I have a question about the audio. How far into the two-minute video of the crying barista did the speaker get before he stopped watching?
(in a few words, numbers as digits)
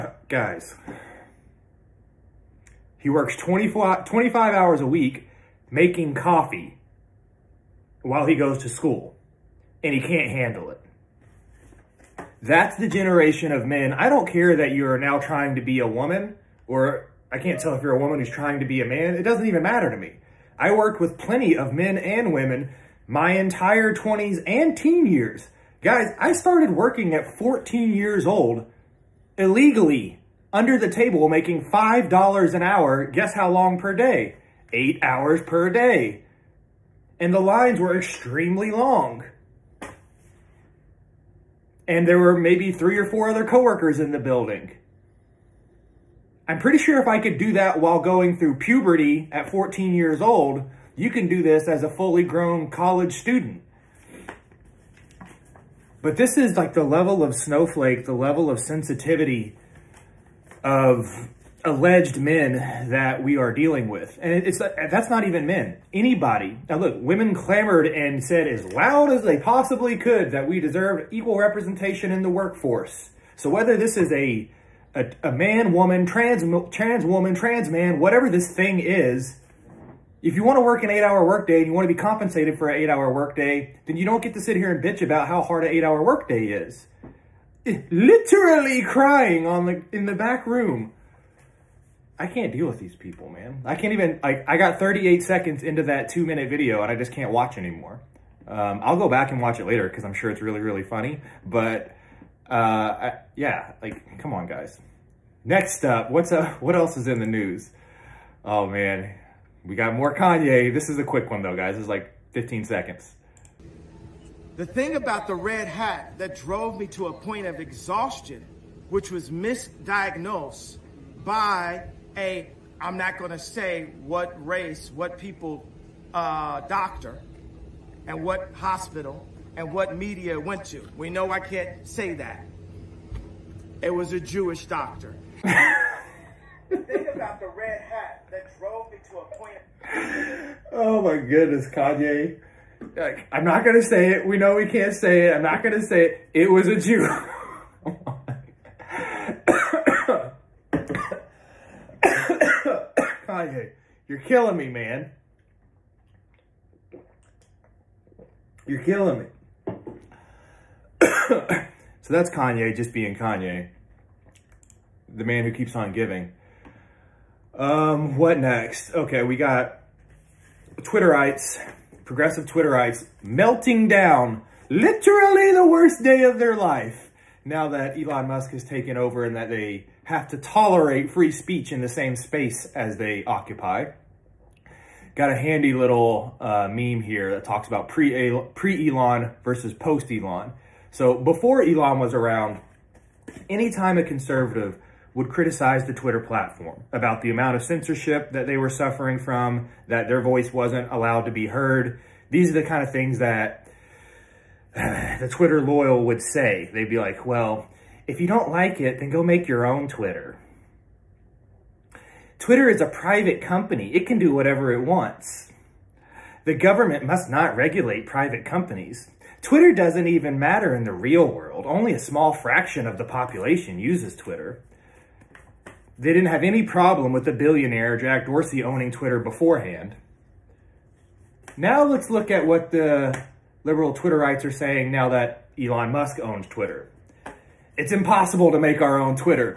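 38 seconds.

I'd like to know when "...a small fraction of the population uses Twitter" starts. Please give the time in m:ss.
3:41.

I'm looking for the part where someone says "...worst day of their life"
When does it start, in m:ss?
2:55.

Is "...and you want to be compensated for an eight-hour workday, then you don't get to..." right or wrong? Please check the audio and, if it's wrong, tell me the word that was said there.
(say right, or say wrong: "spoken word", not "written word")
right.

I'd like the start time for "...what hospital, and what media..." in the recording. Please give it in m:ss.
2:08.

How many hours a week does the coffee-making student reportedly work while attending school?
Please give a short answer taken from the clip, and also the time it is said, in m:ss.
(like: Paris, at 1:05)
24 to 25 hours, at 0:03.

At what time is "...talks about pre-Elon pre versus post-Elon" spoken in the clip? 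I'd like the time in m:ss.
3:07.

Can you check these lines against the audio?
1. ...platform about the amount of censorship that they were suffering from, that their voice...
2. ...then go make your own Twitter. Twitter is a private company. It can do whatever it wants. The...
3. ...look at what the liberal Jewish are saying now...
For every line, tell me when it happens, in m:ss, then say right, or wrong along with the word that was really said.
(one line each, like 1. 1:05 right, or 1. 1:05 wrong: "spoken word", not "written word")
1. 3:16 right
2. 3:28 right
3. 3:52 wrong: "Twitterites", not "Jewish".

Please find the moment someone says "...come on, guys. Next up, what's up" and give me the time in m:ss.
1:44.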